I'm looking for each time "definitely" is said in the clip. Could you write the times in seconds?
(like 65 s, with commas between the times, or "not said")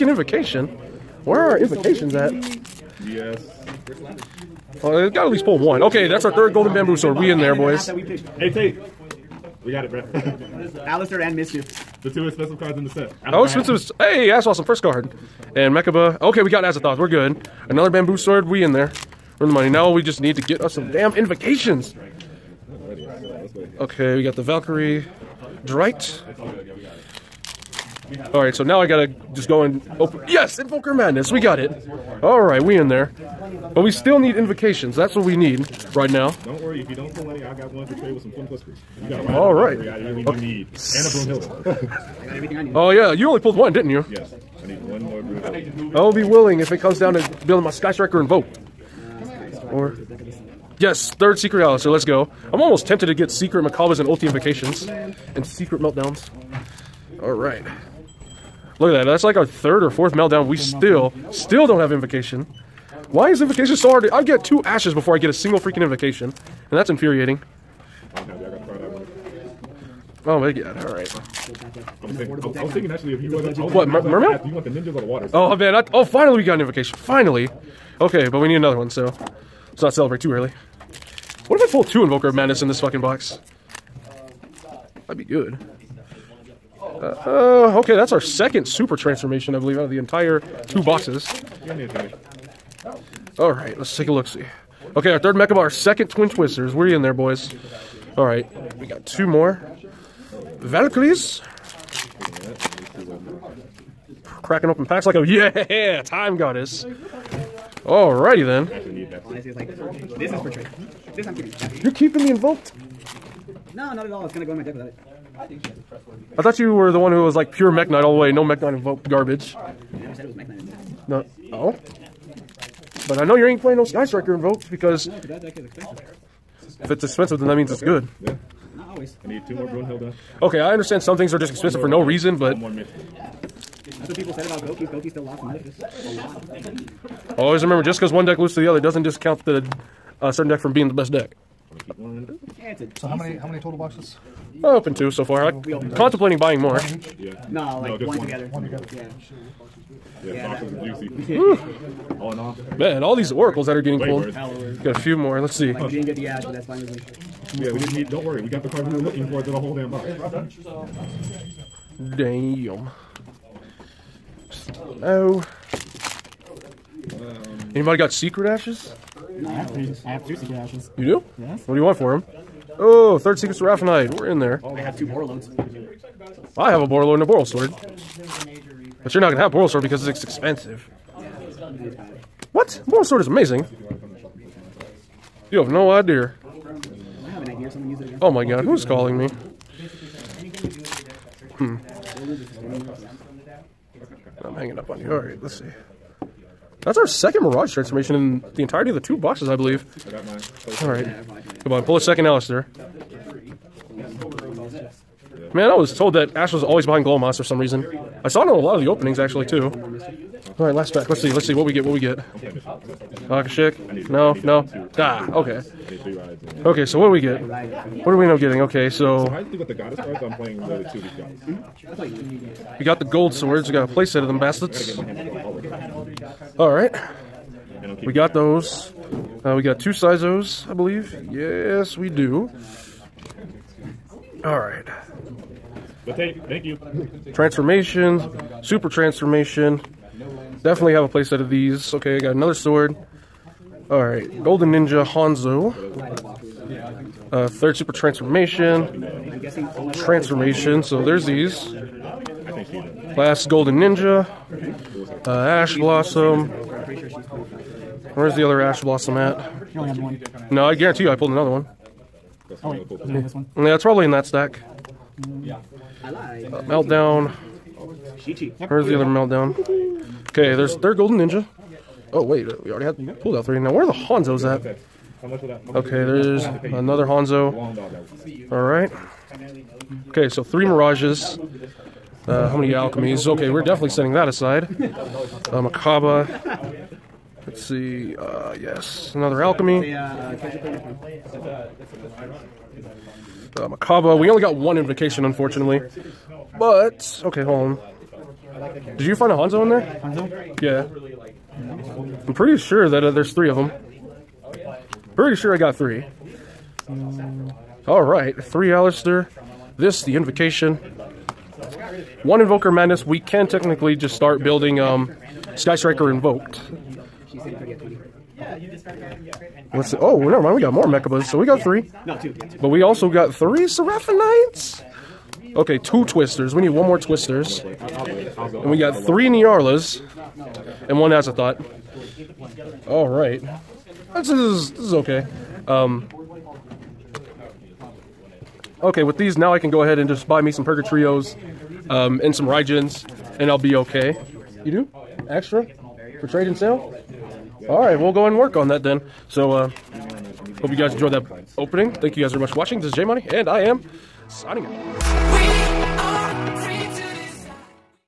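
240 s, 283 s.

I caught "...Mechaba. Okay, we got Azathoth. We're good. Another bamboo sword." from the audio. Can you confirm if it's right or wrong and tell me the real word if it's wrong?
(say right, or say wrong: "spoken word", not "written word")
right.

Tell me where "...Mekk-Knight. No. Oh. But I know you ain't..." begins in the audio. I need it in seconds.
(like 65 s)
120 s.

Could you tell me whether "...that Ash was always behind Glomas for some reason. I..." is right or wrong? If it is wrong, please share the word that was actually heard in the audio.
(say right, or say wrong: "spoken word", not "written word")
right.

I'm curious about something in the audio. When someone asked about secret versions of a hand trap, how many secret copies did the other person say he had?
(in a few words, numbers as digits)
2.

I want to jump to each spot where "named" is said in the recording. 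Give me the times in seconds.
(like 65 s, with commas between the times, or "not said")
not said.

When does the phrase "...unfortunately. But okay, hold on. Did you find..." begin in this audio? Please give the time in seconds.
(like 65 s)
295 s.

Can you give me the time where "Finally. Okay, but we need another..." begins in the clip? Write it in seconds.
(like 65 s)
76 s.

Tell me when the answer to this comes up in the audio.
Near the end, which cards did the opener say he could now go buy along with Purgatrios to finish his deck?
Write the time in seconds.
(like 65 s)
342 s.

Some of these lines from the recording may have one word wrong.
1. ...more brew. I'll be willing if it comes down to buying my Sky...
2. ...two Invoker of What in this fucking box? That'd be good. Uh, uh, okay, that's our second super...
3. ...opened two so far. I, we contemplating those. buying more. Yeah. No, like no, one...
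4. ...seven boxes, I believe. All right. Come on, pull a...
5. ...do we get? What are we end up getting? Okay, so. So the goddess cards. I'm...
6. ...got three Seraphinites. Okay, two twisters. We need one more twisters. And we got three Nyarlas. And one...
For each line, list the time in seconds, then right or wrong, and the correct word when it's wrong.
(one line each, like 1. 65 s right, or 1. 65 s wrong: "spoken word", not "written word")
1. 45 s wrong: "building", not "buying"
2. 81 s wrong: "Madness", not "What"
3. 144 s right
4. 198 s wrong: "two", not "seven"
5. 217 s right
6. 323 s right.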